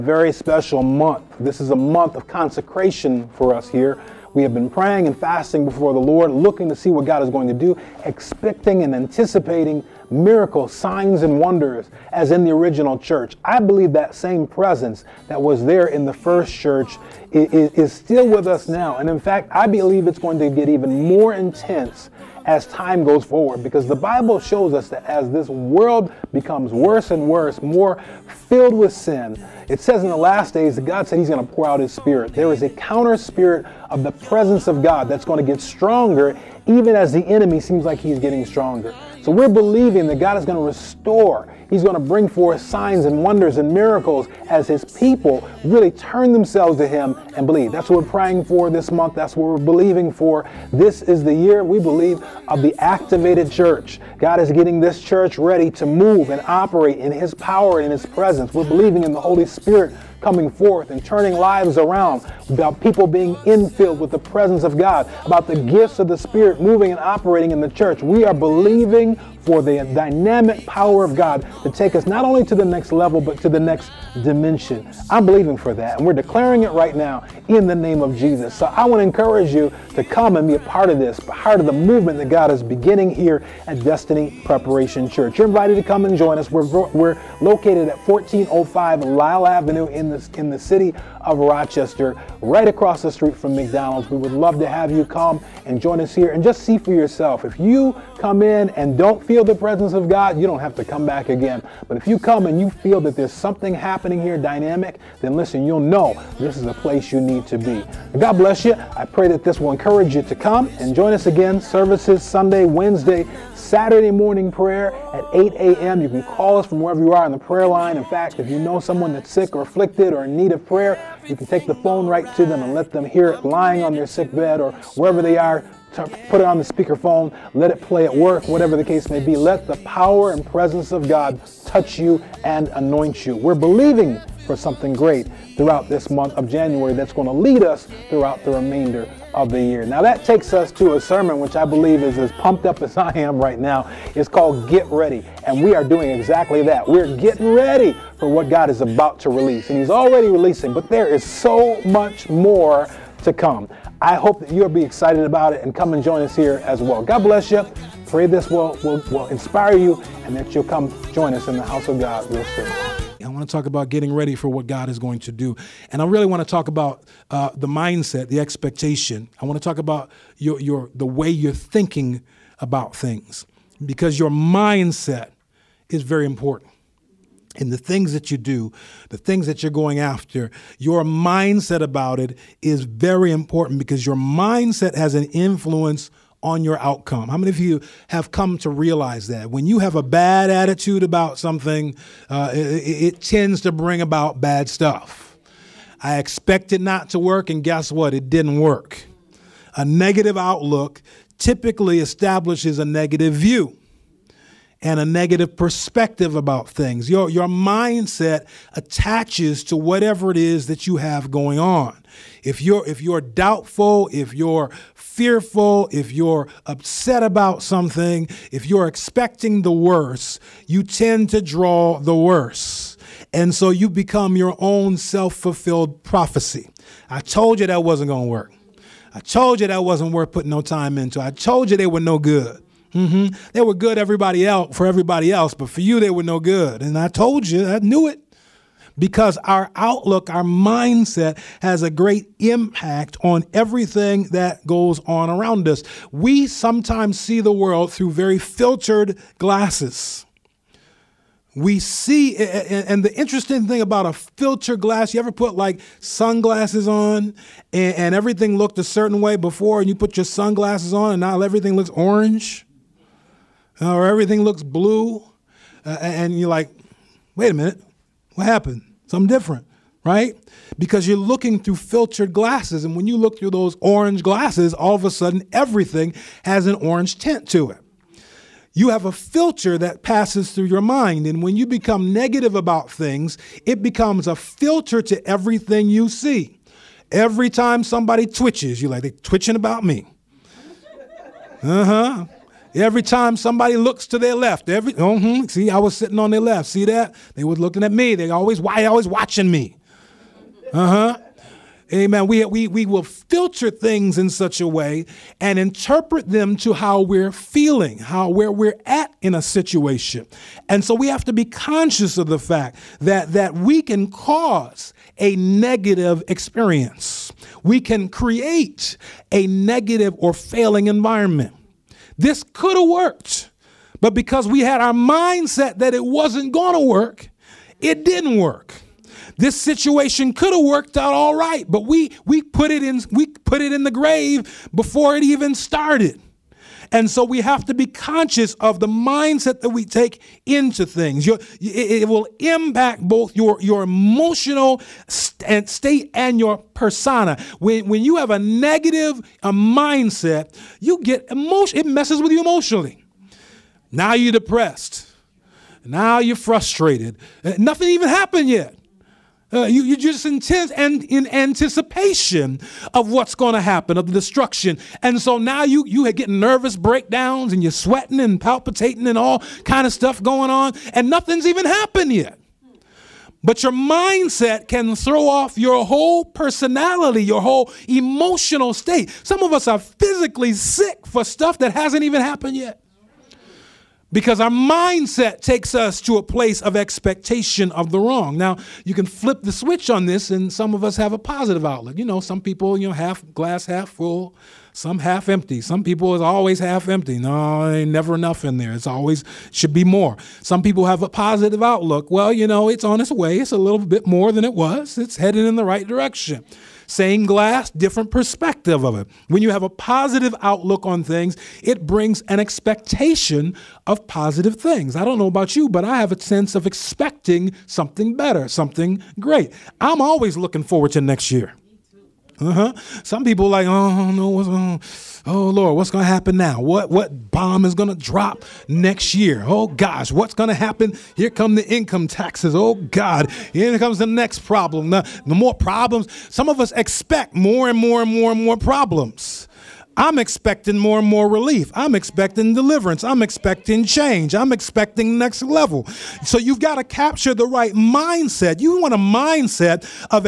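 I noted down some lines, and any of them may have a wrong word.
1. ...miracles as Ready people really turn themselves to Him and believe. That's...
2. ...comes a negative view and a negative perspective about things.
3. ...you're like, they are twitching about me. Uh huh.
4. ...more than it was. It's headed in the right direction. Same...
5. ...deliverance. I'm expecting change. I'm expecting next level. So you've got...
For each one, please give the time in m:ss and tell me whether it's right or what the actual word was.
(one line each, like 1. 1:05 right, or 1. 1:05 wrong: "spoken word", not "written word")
1. 0:43 wrong: "His", not "Ready"
2. 3:21 wrong: "establishes", not "comes"
3. 4:48 right
4. 6:44 right
5. 7:22 right.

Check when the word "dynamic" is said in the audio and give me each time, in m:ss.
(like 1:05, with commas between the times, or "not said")
1:09, 1:44.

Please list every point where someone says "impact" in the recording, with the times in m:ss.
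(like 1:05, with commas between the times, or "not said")
4:02, 5:42.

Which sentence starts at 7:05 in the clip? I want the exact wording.
Oh Lord, what's gonna happen now?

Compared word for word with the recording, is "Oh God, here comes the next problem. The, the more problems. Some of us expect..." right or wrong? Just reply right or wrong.
right.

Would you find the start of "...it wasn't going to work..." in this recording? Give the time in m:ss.
5:25.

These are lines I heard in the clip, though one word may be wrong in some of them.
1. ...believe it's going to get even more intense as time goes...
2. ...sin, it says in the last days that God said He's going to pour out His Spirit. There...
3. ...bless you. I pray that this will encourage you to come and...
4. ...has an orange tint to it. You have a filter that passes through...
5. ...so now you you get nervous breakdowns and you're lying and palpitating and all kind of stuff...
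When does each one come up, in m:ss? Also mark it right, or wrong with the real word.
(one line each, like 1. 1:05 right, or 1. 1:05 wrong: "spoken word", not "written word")
1. 0:19 right
2. 0:28 right
3. 1:48 right
4. 4:36 right
5. 6:05 wrong: "sweating", not "lying".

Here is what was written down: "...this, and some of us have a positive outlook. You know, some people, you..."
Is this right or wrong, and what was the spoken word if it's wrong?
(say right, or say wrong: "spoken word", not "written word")
right.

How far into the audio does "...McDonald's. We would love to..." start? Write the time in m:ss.
1:33.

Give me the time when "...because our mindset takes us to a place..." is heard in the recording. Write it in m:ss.
6:24.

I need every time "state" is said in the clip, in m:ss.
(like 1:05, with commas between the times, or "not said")
5:45, 6:18.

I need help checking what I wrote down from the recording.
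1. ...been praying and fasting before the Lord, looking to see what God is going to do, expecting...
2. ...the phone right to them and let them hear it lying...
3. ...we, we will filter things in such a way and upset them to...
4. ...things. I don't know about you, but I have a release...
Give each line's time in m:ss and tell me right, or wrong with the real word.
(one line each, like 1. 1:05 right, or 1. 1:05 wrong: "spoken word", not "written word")
1. 0:04 right
2. 2:01 right
3. 5:02 wrong: "interpret", not "upset"
4. 6:54 wrong: "sense", not "release".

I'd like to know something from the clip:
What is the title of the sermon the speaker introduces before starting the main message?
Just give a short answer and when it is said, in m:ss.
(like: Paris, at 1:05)
Get Ready, at 2:24.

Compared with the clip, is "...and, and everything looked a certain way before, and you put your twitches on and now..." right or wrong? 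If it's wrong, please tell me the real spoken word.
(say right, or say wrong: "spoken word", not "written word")
wrong: "sunglasses", not "twitches".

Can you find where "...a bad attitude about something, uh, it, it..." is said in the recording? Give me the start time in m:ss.
3:09.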